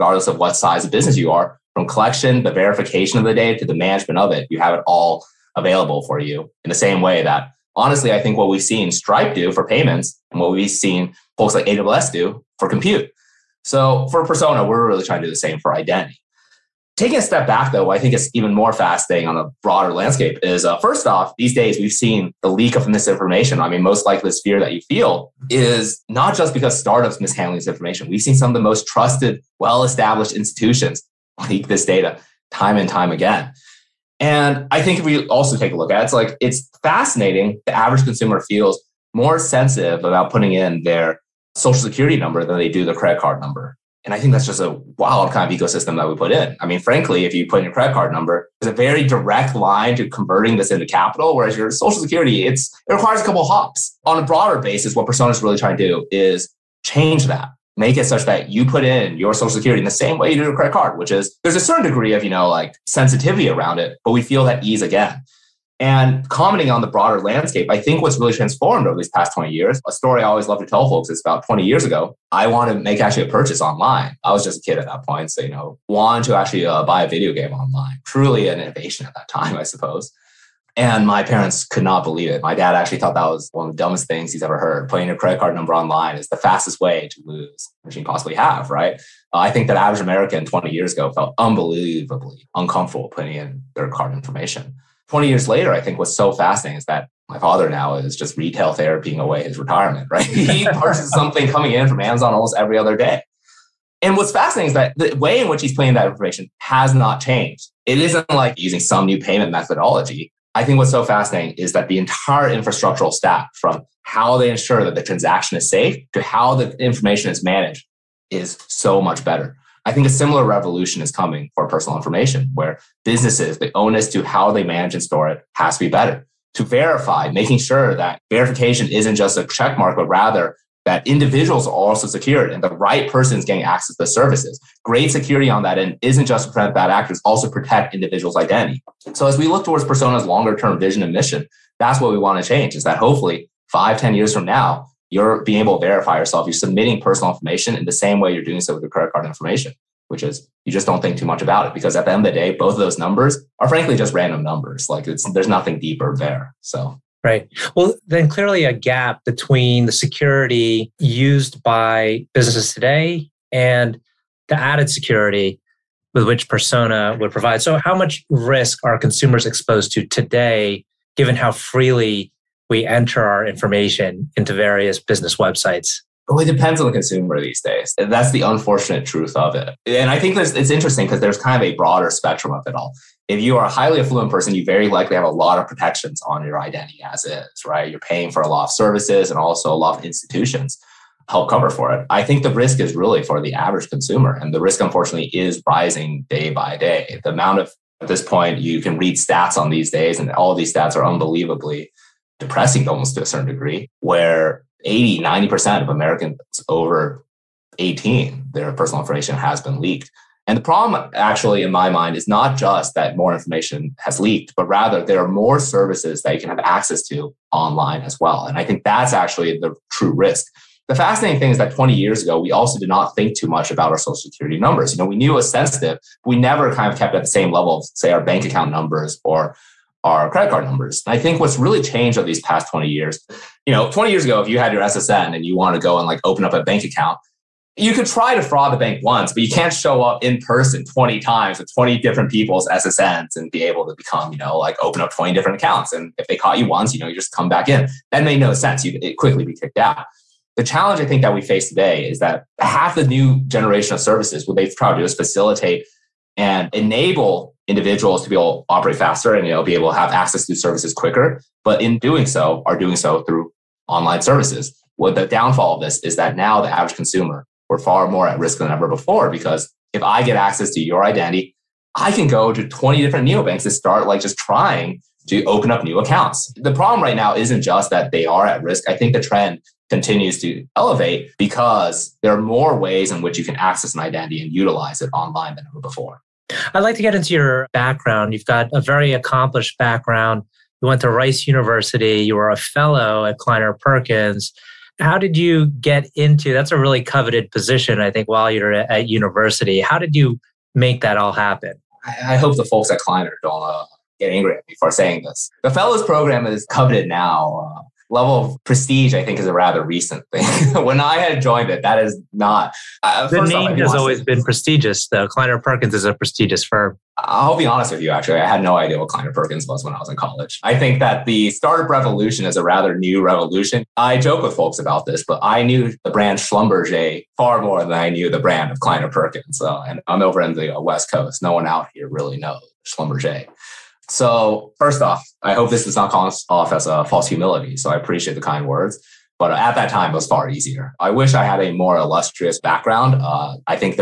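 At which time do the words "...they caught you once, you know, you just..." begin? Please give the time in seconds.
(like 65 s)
246 s.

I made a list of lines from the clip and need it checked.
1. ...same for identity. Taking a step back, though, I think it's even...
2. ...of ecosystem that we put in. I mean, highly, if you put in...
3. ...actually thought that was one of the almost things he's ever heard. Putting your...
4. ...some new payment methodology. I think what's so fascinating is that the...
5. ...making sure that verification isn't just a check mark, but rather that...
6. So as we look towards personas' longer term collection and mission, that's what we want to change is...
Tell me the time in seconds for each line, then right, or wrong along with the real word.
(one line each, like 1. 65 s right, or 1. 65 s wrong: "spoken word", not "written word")
1. 15 s right
2. 45 s wrong: "frankly", not "highly"
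3. 82 s wrong: "dumbest", not "almost"
4. 108 s right
5. 127 s right
6. 139 s wrong: "vision", not "collection".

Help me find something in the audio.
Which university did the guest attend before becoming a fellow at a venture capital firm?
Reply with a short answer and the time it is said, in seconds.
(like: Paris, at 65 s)
Rice University, at 291 s.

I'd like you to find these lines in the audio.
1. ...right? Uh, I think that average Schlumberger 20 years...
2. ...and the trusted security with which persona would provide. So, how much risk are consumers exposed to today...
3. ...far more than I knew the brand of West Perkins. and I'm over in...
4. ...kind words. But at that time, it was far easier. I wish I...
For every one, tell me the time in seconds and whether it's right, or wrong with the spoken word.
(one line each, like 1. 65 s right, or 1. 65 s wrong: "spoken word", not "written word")
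1. 88 s wrong: "American", not "Schlumberger"
2. 163 s wrong: "added", not "trusted"
3. 327 s wrong: "Kleiner", not "West"
4. 338 s right.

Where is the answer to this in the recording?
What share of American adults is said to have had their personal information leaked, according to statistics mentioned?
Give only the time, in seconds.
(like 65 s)
204 s.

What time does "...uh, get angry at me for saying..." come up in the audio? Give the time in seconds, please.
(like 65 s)
303 s.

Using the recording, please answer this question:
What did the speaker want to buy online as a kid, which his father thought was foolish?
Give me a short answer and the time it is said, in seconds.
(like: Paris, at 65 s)
A video game, at 77 s.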